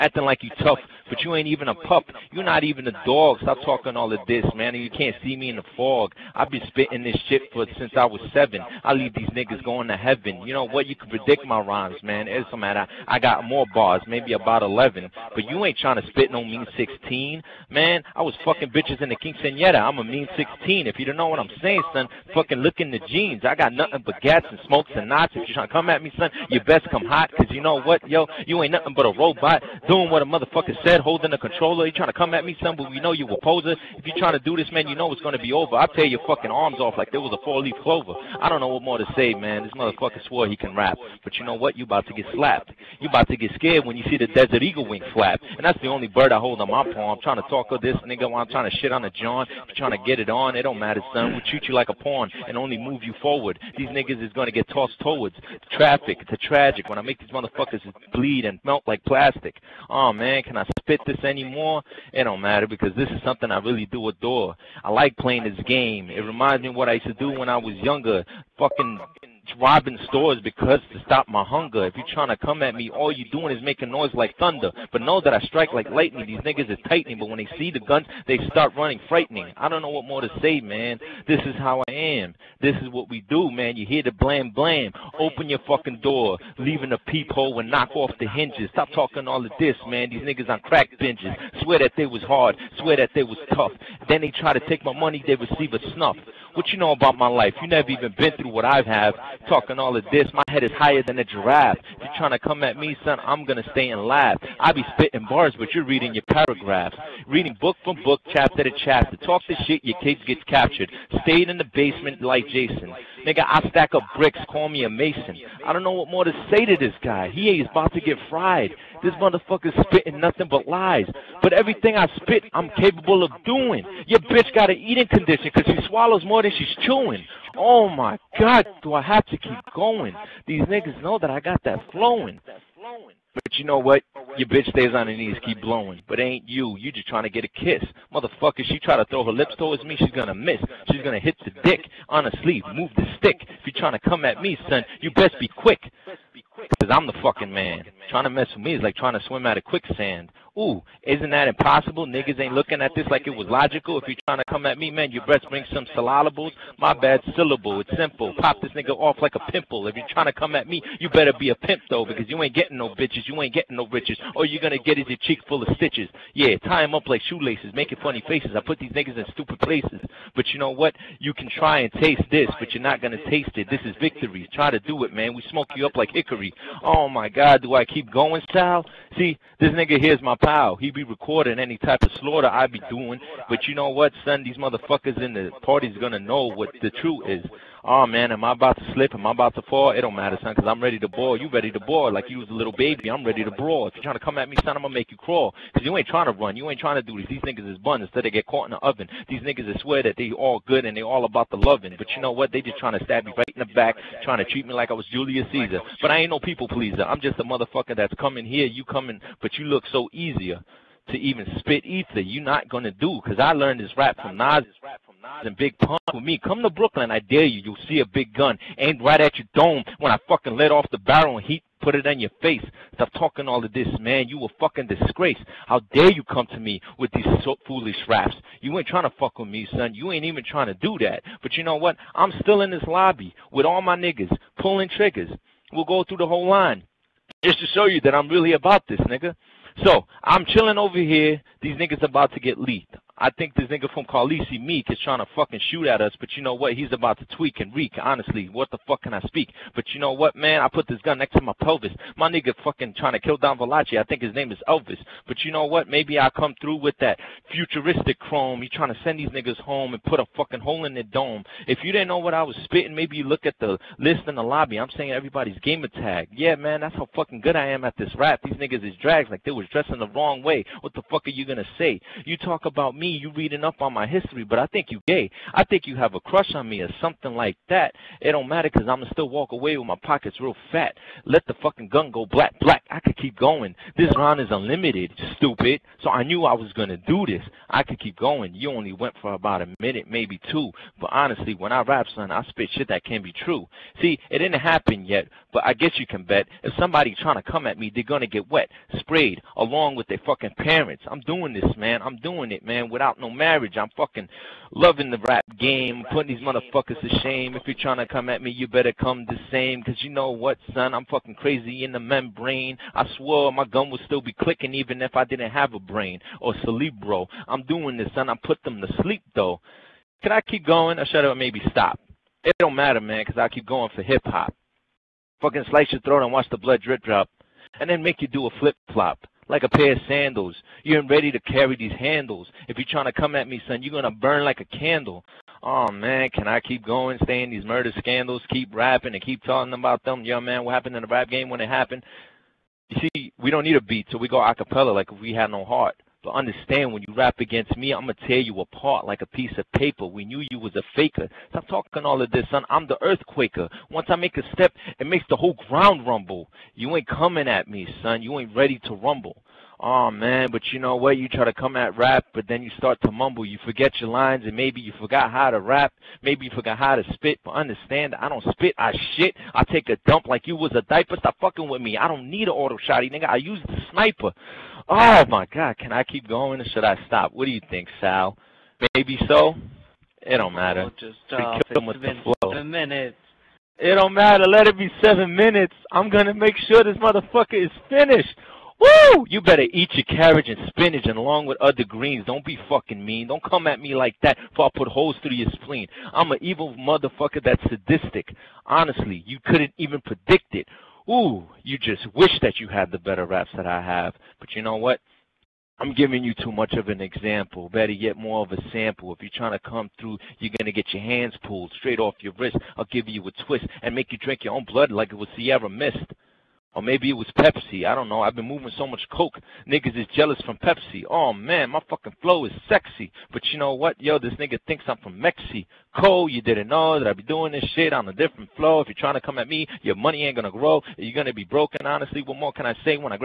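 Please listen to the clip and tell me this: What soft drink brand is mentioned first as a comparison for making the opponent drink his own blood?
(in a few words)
Sierra Mist.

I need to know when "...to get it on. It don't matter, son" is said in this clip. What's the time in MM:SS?
00:49.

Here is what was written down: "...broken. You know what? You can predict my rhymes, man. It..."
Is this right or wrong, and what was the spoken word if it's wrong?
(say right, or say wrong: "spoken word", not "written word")
wrong: "heaven", not "broken".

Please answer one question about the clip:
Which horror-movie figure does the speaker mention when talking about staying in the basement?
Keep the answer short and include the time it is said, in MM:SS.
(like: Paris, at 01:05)
Jason, at 01:52.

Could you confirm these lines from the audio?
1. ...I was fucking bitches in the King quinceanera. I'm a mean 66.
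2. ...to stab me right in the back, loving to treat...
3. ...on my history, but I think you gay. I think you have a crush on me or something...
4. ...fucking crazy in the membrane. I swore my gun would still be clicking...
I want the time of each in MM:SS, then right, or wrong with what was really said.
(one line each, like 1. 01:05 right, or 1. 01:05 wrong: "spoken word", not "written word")
1. 00:18 wrong: "16", not "66"
2. 03:22 wrong: "trying", not "loving"
3. 04:33 right
4. 05:11 right.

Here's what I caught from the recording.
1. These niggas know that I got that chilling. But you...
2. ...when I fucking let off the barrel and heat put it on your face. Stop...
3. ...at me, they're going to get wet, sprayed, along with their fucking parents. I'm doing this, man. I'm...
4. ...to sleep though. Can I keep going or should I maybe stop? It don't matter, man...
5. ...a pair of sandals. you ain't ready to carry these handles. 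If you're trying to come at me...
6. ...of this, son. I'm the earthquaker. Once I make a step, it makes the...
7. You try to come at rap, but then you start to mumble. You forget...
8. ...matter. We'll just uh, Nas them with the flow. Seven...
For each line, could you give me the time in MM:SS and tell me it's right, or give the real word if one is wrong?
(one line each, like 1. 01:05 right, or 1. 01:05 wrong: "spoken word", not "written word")
1. 02:10 wrong: "flowing", not "chilling"
2. 03:39 right
3. 04:57 right
4. 05:18 right
5. 05:29 right
6. 05:52 right
7. 06:01 right
8. 06:20 wrong: "Kill", not "Nas".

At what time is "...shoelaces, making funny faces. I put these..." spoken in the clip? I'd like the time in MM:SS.
02:47.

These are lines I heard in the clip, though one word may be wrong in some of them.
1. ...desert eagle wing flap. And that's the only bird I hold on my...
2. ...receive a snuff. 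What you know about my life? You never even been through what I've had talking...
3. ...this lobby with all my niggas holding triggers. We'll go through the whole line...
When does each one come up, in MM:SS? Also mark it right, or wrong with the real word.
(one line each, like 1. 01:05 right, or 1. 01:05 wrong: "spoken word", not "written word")
1. 00:44 right
2. 01:35 right
3. 03:52 wrong: "pulling", not "holding".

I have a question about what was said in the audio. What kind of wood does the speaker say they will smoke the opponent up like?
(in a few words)
hickory.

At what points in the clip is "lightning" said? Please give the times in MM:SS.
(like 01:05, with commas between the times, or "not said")
01:15.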